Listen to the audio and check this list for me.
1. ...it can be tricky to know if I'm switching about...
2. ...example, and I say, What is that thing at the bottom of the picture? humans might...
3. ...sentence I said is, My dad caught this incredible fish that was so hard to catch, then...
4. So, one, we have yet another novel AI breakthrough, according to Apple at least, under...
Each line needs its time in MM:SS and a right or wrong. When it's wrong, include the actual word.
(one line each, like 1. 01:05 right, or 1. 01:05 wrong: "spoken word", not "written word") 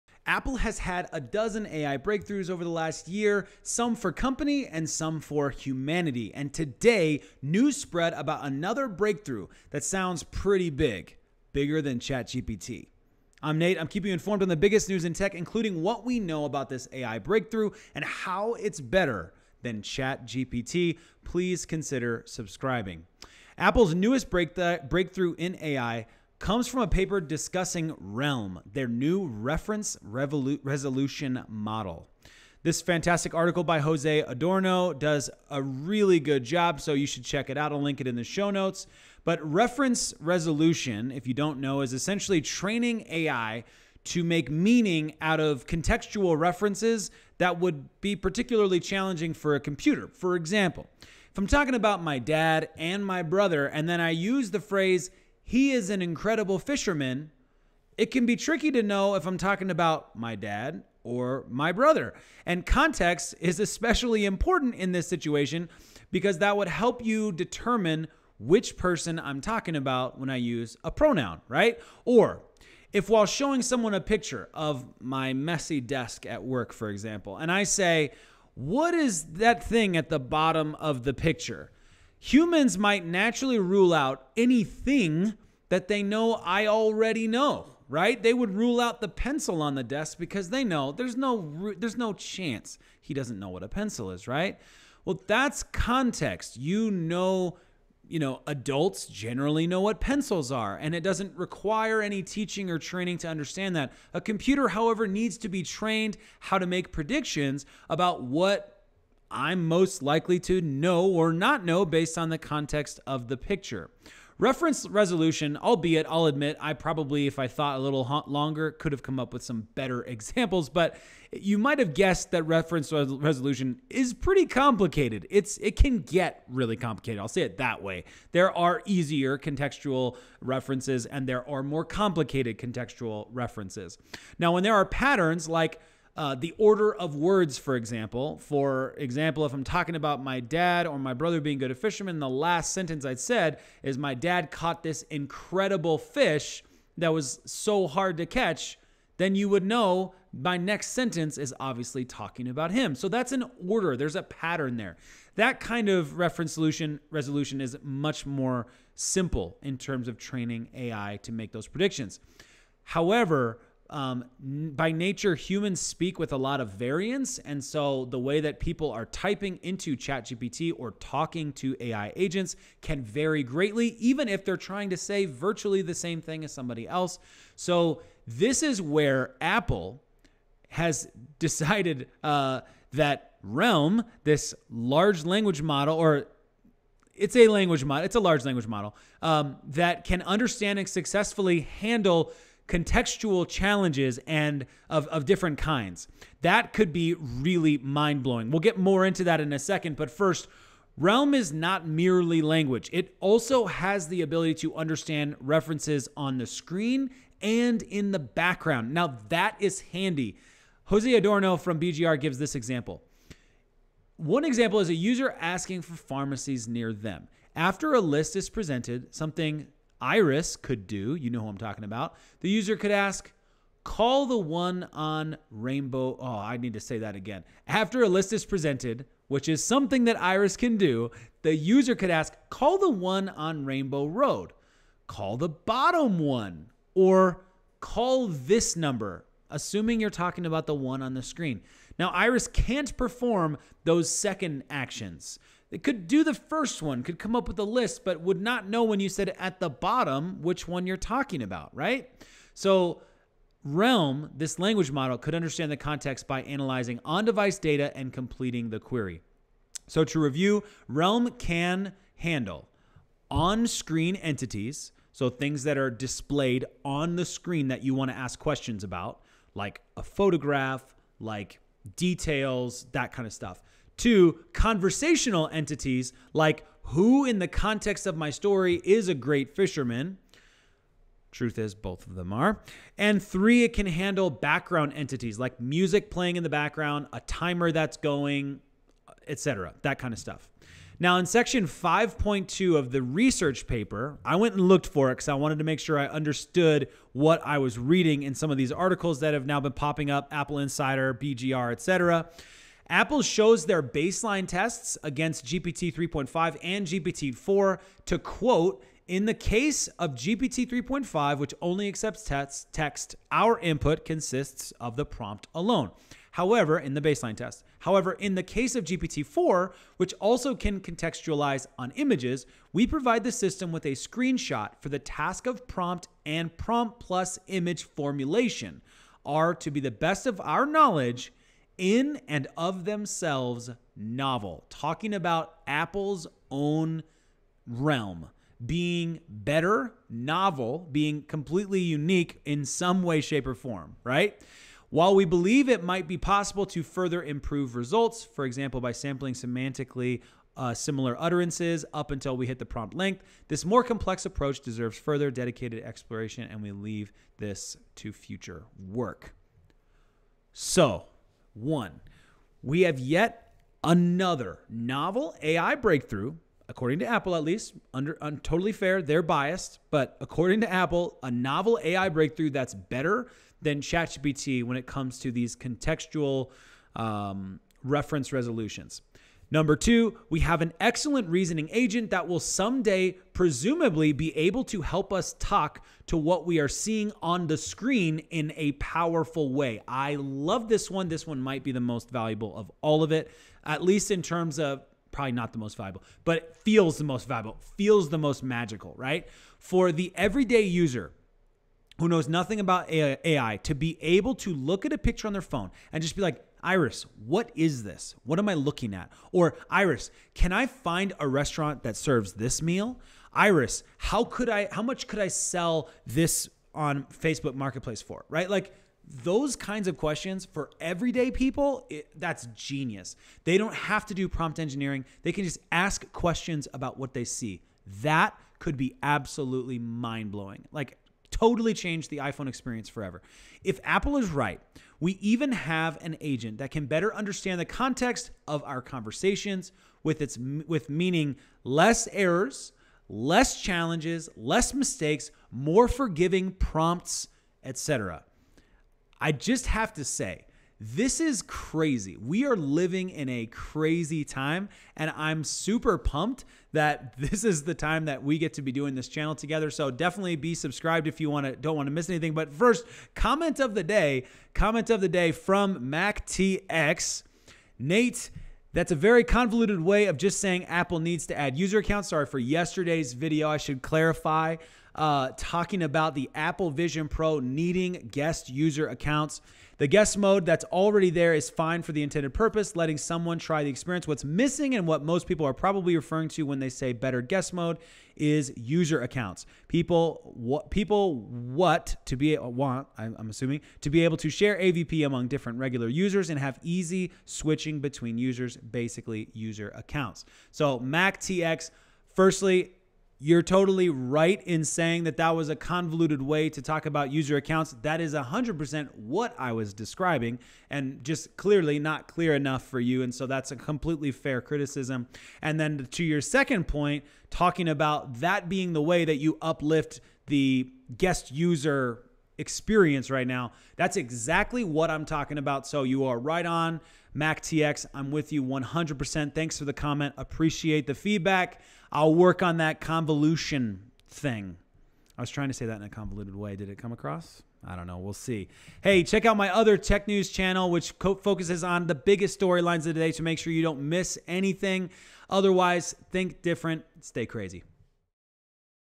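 1. 00:57 wrong: "talking", not "switching"
2. 01:16 right
3. 02:22 right
4. 06:00 right.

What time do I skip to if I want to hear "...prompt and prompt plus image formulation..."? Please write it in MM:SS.
05:25.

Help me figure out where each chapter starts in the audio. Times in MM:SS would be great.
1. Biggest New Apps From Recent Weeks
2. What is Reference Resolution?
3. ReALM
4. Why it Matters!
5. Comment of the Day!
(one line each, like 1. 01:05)
1. 00:23
2. 00:38
3. 02:55
4. 06:00
5. 07:43.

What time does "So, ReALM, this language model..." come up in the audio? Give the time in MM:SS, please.
04:12.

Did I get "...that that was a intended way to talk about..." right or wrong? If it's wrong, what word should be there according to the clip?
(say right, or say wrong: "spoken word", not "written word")
wrong: "convoluted", not "intended".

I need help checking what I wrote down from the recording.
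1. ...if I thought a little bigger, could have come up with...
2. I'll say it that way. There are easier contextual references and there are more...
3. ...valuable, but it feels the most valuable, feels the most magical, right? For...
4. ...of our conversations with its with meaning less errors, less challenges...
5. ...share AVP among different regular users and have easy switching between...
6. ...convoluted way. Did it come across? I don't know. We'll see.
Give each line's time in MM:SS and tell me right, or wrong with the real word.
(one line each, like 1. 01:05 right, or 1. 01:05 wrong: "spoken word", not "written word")
1. 01:57 wrong: "longer", not "bigger"
2. 02:07 right
3. 06:35 right
4. 07:18 right
5. 08:14 right
6. 08:55 right.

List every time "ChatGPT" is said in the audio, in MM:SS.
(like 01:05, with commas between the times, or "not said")
00:11, 00:19, 02:49, 06:13.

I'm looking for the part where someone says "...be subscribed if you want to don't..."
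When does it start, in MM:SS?
07:40.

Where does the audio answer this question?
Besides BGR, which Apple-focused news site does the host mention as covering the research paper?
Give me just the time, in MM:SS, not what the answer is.
05:00.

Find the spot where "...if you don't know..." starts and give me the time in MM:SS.
00:41.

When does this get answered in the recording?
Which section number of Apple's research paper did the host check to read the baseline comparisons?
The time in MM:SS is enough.
04:51.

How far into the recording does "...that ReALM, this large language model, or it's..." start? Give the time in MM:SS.
03:02.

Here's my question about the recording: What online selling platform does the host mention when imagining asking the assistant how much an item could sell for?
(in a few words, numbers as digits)
Facebook Marketplace.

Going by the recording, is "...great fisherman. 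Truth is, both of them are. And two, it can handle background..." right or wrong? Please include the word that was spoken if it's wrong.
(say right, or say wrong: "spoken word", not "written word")
wrong: "three", not "two".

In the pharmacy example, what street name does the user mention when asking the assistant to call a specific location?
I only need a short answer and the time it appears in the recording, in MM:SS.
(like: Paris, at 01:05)
Rainbow Road, at 03:53.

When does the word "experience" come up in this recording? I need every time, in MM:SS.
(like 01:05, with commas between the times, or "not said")
07:12, 08:03, 08:42.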